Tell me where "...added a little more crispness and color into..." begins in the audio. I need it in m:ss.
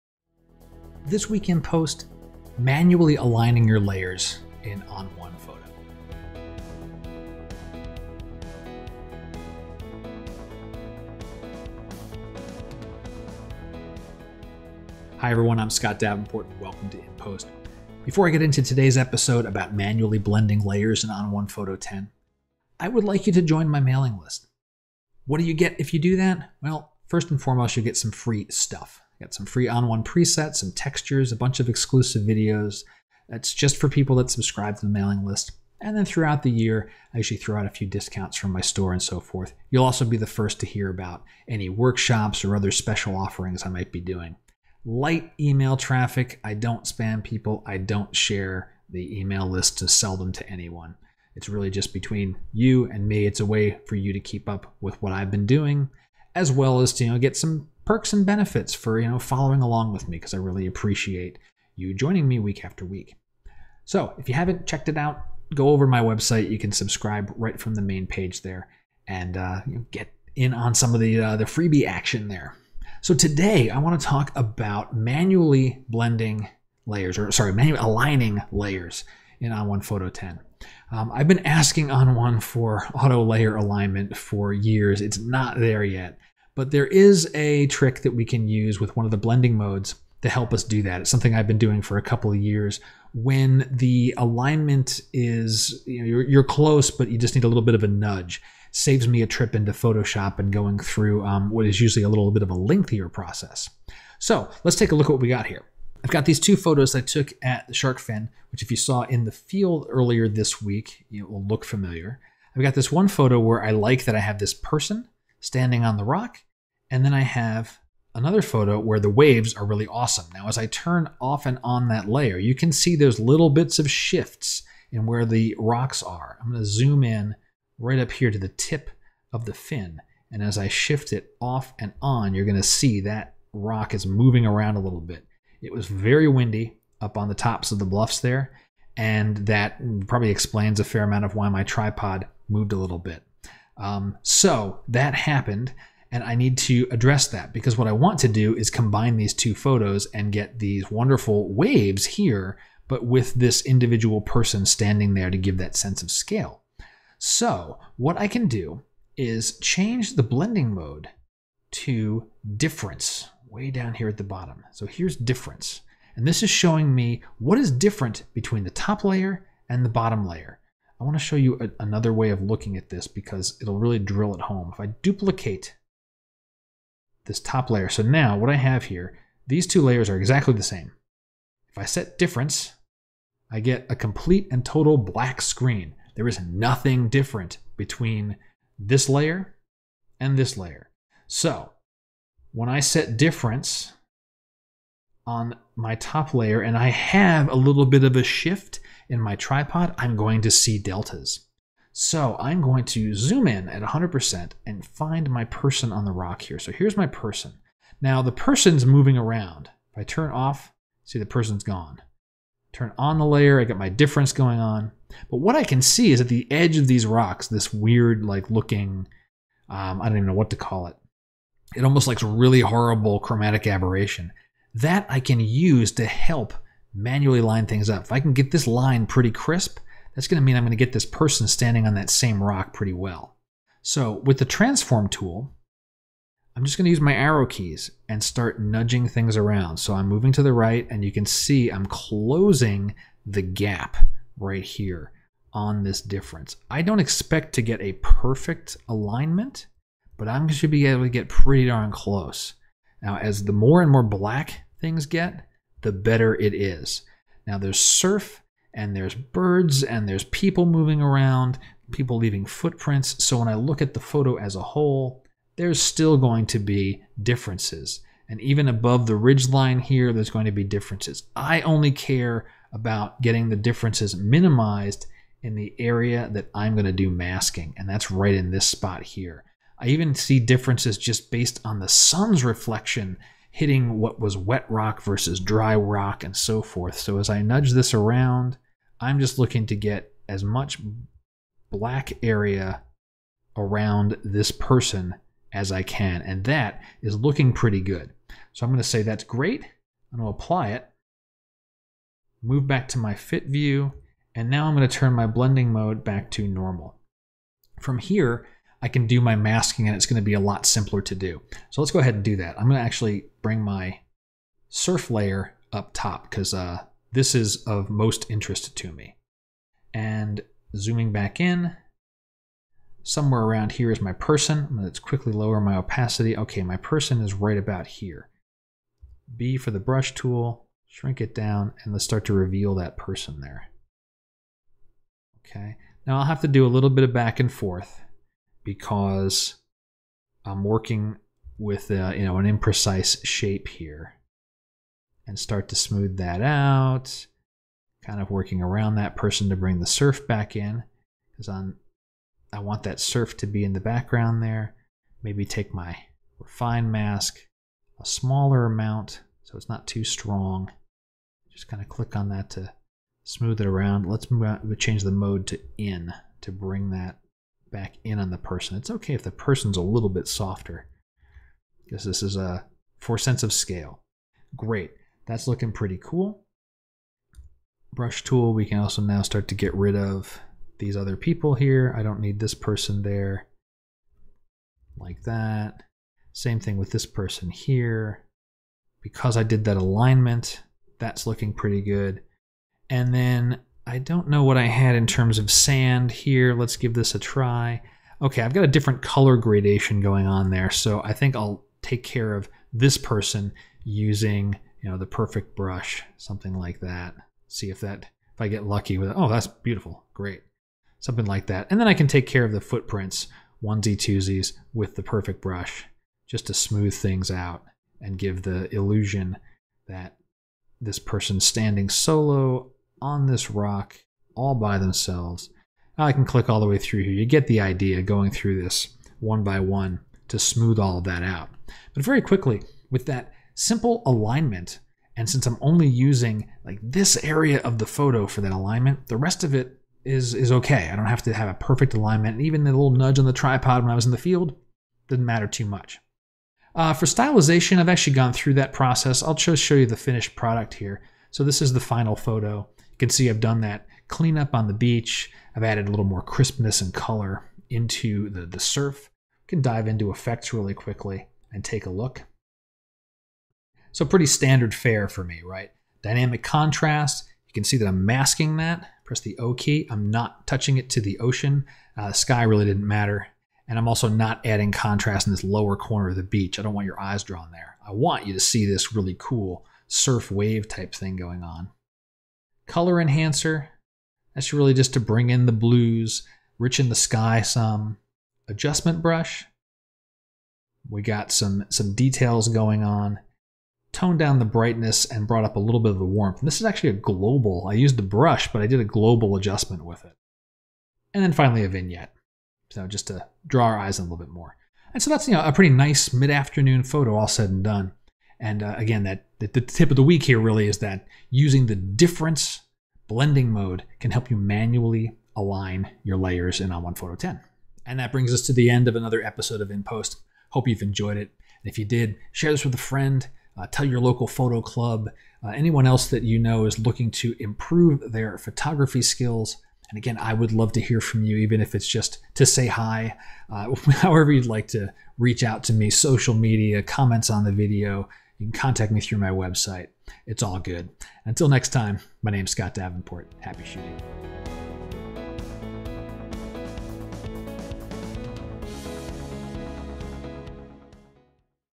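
7:35.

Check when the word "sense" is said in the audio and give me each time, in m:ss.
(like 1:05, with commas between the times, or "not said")
2:35, 6:13.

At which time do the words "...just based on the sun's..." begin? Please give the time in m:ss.
4:40.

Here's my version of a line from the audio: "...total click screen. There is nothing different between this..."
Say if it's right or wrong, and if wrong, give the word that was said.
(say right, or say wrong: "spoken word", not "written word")
wrong: "black", not "click".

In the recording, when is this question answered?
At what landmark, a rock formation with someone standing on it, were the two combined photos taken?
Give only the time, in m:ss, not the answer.
1:47.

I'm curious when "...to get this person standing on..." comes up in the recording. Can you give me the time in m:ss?
3:50.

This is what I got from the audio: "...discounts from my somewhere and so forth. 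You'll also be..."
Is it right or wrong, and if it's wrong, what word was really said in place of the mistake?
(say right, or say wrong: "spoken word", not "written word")
wrong: "store", not "somewhere".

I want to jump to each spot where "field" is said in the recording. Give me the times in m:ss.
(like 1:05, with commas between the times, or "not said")
1:49, 7:24.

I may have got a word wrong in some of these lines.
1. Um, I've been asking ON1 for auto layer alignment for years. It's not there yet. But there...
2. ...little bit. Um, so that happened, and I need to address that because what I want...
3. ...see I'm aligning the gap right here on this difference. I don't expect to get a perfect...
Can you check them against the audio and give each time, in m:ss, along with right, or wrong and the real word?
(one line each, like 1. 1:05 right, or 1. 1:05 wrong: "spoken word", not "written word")
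1. 1:20 right
2. 2:22 right
3. 4:01 wrong: "closing", not "aligning".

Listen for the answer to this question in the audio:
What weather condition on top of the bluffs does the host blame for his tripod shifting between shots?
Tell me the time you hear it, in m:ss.
2:15.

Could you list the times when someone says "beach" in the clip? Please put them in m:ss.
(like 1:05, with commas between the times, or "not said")
7:34, 7:56.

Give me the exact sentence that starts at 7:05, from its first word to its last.
Now I can click all the way through here.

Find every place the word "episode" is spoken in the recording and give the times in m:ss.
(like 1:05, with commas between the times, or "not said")
0:18, 8:39.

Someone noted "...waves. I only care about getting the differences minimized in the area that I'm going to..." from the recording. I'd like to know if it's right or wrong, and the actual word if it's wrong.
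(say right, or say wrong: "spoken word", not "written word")
wrong: "differences", not "waves".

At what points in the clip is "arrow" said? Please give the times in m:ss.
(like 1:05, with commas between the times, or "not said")
3:57.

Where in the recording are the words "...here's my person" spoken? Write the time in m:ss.
3:26.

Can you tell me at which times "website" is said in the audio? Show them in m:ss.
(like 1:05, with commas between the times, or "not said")
1:06, 8:59.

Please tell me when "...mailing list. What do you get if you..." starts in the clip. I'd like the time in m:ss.
0:23.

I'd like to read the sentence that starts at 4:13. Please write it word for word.
Now, as the more and more black things get, the better it is.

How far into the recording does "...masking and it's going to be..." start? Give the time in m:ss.
5:09.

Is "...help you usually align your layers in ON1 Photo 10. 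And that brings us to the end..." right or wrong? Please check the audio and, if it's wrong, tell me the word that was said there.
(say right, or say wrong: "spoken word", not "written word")
wrong: "manually", not "usually".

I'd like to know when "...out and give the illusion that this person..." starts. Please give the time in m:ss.
6:57.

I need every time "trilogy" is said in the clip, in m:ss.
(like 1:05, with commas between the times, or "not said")
not said.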